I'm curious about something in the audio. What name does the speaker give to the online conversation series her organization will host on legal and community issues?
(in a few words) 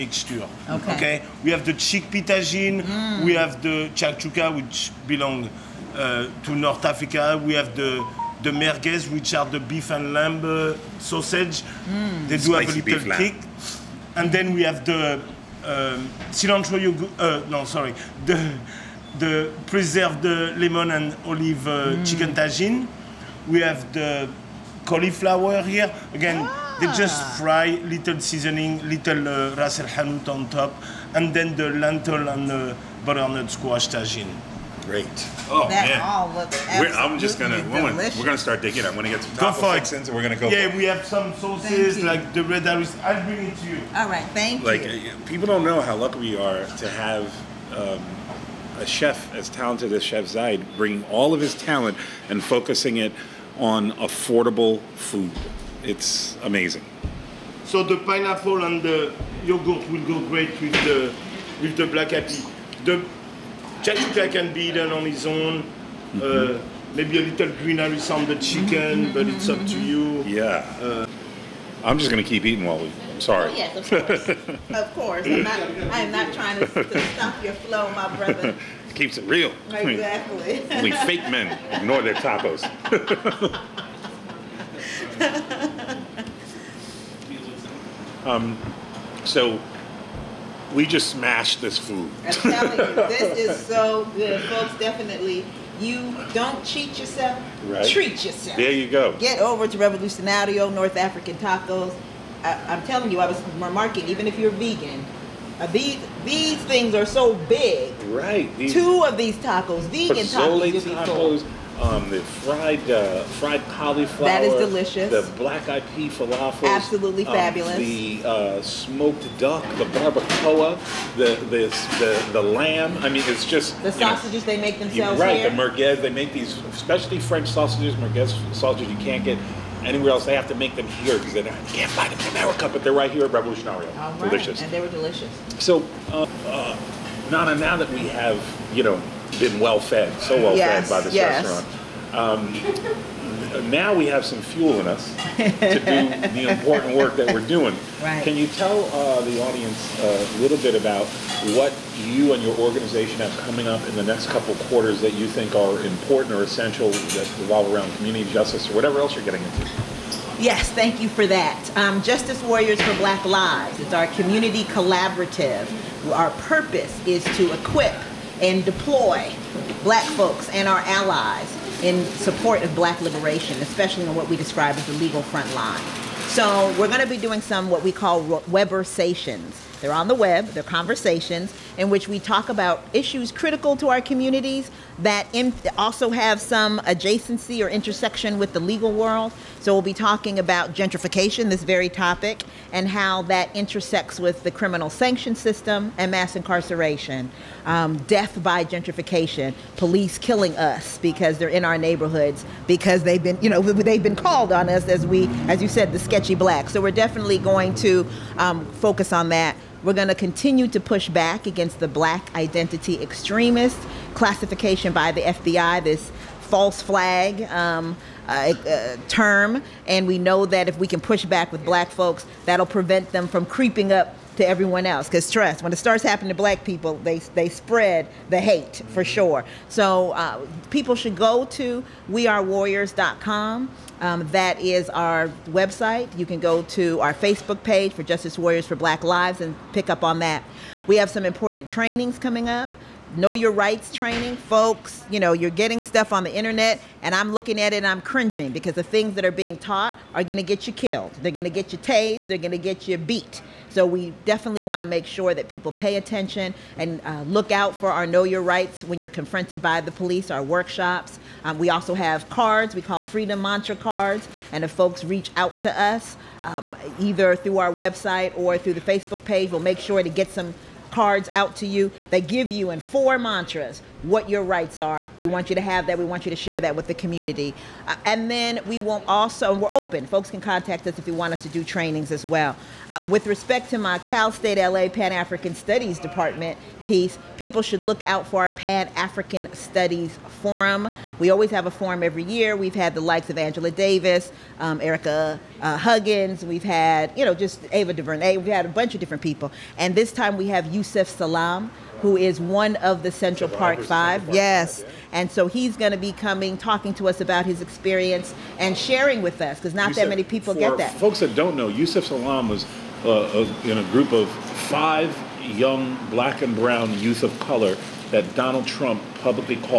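Webersations.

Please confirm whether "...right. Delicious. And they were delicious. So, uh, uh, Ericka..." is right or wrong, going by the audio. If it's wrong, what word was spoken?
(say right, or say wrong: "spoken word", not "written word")
wrong: "Nana", not "Ericka".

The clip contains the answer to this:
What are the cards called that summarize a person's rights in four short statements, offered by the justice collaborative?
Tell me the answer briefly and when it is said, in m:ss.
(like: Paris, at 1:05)
Freedom Mantra cards, at 4:23.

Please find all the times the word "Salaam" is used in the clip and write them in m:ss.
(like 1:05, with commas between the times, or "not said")
5:01, 5:12.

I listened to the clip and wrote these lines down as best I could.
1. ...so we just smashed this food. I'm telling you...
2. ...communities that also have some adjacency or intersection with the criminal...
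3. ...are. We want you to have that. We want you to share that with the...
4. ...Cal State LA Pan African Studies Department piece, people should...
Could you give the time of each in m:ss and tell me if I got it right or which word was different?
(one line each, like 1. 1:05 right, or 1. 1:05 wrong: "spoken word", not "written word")
1. 1:29 right
2. 3:04 wrong: "legal", not "criminal"
3. 4:34 right
4. 4:43 right.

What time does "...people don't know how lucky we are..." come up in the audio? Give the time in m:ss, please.
0:45.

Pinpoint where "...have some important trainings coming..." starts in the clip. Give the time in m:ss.
4:00.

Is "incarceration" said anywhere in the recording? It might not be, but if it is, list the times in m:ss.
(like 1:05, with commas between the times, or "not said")
3:16.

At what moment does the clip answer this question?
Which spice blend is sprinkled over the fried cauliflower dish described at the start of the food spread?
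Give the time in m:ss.
0:29.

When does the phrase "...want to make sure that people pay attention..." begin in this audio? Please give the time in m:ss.
4:14.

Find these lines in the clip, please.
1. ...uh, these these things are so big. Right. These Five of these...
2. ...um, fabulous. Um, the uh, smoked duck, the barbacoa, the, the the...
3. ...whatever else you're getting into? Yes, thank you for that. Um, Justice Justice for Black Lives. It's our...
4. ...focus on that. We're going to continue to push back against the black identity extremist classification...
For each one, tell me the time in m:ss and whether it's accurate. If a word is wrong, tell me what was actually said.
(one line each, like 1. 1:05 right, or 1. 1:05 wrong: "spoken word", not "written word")
1. 1:45 wrong: "Two", not "Five"
2. 1:57 right
3. 2:38 wrong: "Warriors", not "Justice"
4. 3:28 right.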